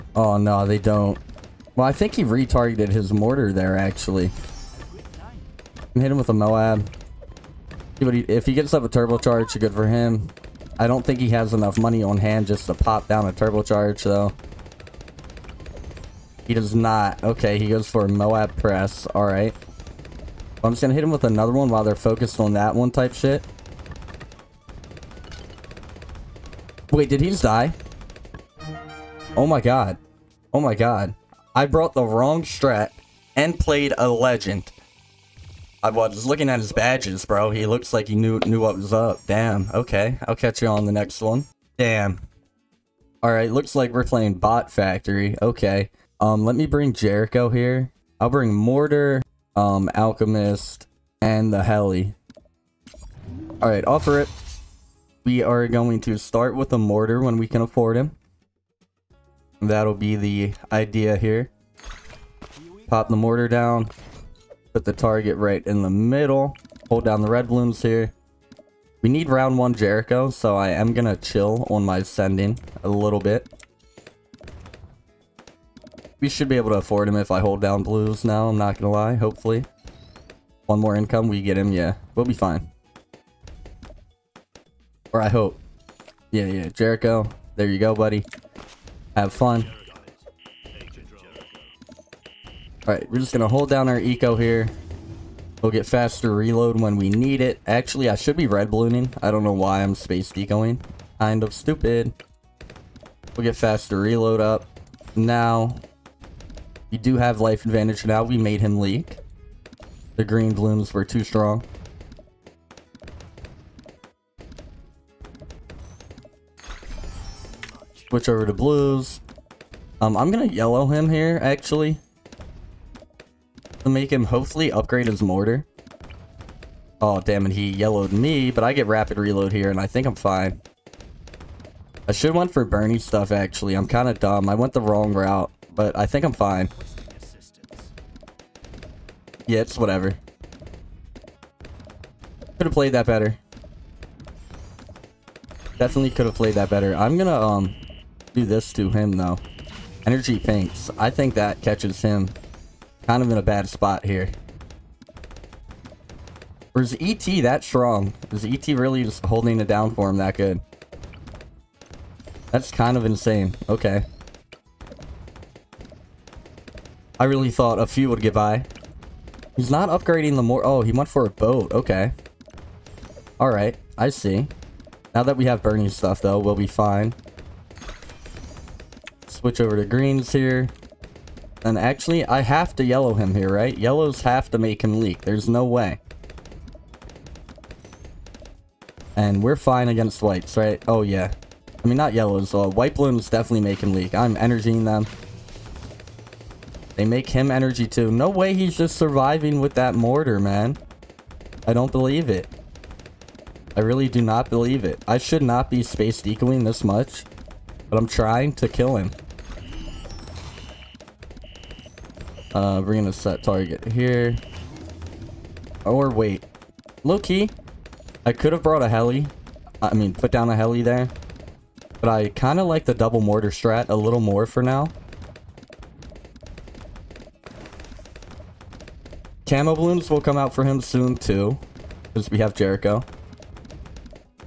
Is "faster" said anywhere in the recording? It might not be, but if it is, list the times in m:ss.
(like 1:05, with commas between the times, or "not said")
1:35, 1:43.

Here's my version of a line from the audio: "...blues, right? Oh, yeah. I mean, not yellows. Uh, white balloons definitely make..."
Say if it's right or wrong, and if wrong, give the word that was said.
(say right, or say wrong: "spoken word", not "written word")
wrong: "whites", not "blues".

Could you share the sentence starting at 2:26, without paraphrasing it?
I'm gonna um do this to him though.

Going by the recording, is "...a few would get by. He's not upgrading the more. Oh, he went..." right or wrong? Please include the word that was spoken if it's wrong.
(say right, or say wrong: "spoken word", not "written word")
right.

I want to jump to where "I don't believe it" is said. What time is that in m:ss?
3:21.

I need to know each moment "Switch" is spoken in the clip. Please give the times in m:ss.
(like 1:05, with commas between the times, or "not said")
1:58, 2:59.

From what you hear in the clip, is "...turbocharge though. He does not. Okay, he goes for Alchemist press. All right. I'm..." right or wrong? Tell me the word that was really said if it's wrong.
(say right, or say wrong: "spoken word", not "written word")
wrong: "Moab", not "Alchemist".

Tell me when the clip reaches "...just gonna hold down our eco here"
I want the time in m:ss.
1:33.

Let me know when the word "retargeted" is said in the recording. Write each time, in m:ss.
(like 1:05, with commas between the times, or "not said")
0:02.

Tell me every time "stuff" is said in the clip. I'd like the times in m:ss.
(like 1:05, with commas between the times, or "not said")
2:13, 2:55.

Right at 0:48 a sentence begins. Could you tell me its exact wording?
I'll bring Mortar, um, Alchemist, and the Heli.